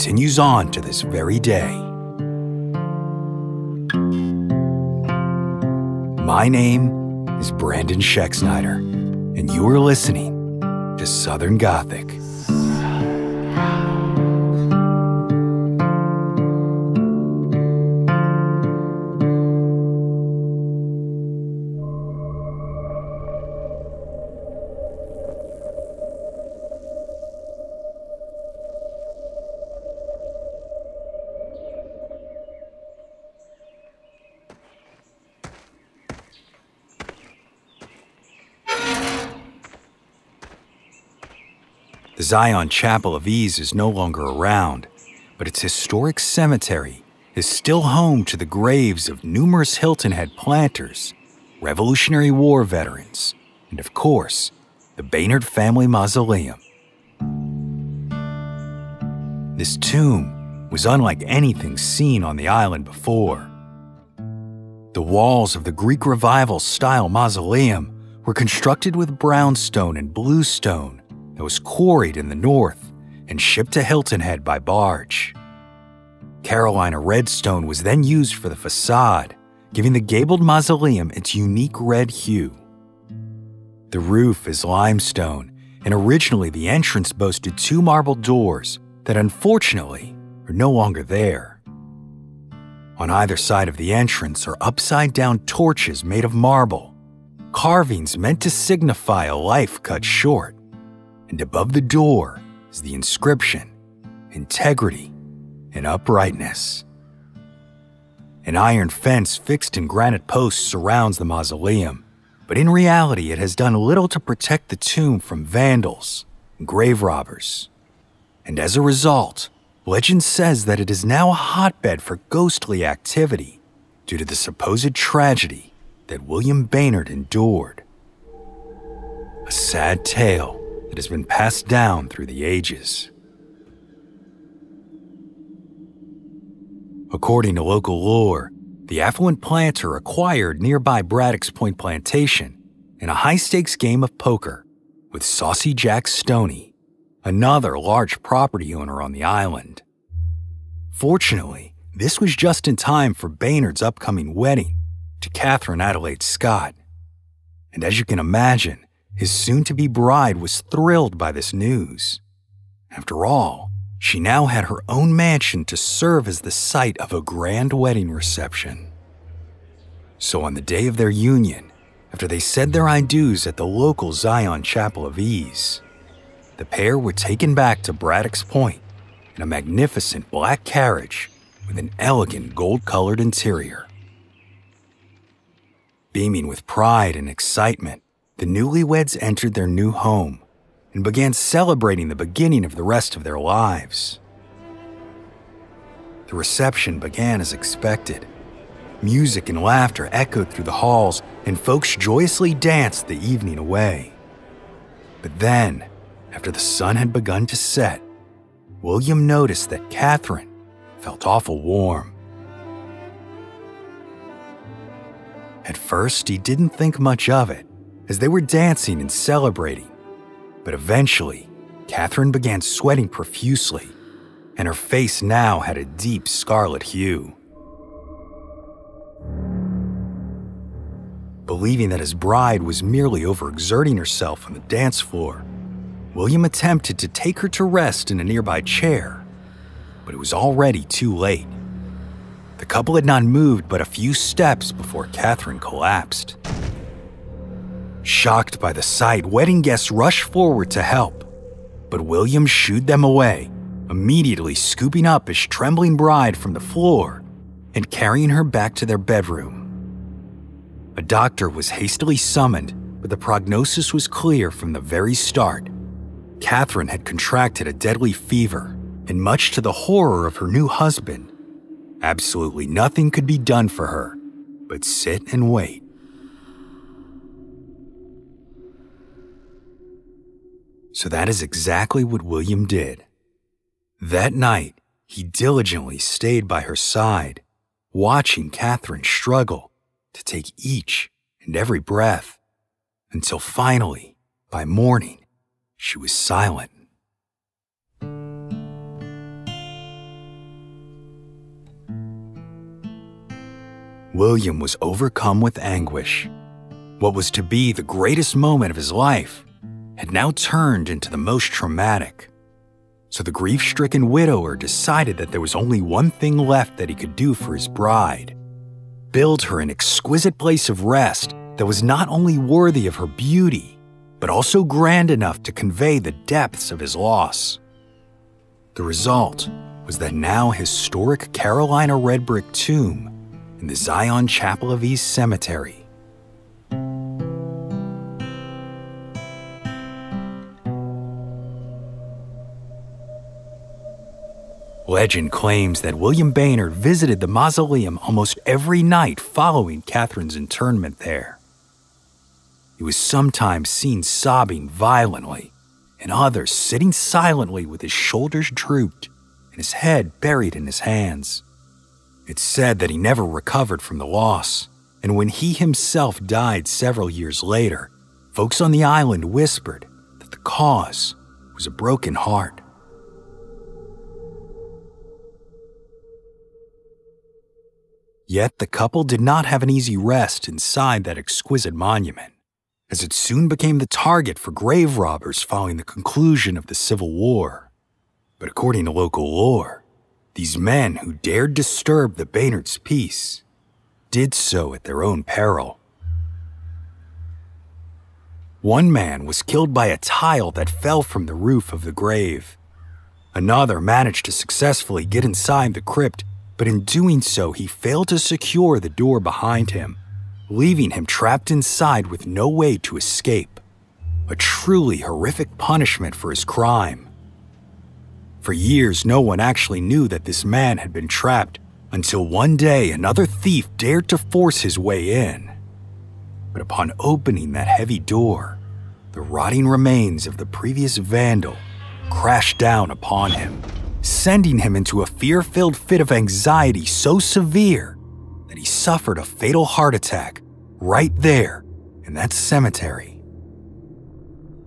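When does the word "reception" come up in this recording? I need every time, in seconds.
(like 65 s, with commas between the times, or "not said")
168 s, 196 s.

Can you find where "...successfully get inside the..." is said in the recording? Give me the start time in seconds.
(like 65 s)
404 s.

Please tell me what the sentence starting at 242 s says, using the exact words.
The couple had not moved but a few steps before Catherine collapsed.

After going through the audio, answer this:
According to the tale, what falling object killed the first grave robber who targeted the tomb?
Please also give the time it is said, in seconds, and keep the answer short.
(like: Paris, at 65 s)
A tile, at 399 s.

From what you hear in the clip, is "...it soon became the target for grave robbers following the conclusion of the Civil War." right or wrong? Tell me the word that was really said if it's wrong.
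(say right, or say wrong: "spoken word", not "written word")
right.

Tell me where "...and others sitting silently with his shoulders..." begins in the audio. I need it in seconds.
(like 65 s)
355 s.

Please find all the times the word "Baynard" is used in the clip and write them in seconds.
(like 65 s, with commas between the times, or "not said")
55 s, 126 s, 153 s, 346 s, 392 s.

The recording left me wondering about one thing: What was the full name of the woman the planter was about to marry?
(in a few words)
Catherine Adelaide Scott.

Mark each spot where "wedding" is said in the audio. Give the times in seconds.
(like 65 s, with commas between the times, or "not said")
154 s, 167 s, 249 s.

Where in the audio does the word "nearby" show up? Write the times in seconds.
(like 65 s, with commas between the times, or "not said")
140 s, 238 s.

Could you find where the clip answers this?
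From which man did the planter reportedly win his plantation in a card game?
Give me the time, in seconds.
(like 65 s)
145 s.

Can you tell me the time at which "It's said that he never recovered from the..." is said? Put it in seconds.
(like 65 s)
362 s.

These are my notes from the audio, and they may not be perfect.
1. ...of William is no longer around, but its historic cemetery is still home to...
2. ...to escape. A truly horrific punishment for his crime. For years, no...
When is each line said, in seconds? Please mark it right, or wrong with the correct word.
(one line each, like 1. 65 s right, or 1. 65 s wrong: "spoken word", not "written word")
1. 43 s wrong: "Ease", not "William"
2. 412 s right.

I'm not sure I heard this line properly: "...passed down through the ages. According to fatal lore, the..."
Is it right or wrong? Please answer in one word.
wrong.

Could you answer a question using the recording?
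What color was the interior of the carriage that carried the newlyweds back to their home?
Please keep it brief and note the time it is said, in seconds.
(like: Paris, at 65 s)
Gold, at 182 s.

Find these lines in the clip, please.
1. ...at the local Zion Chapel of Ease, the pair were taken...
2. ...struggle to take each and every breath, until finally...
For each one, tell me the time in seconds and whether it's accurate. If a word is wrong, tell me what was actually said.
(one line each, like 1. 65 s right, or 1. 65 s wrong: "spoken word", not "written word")
1. 173 s right
2. 289 s right.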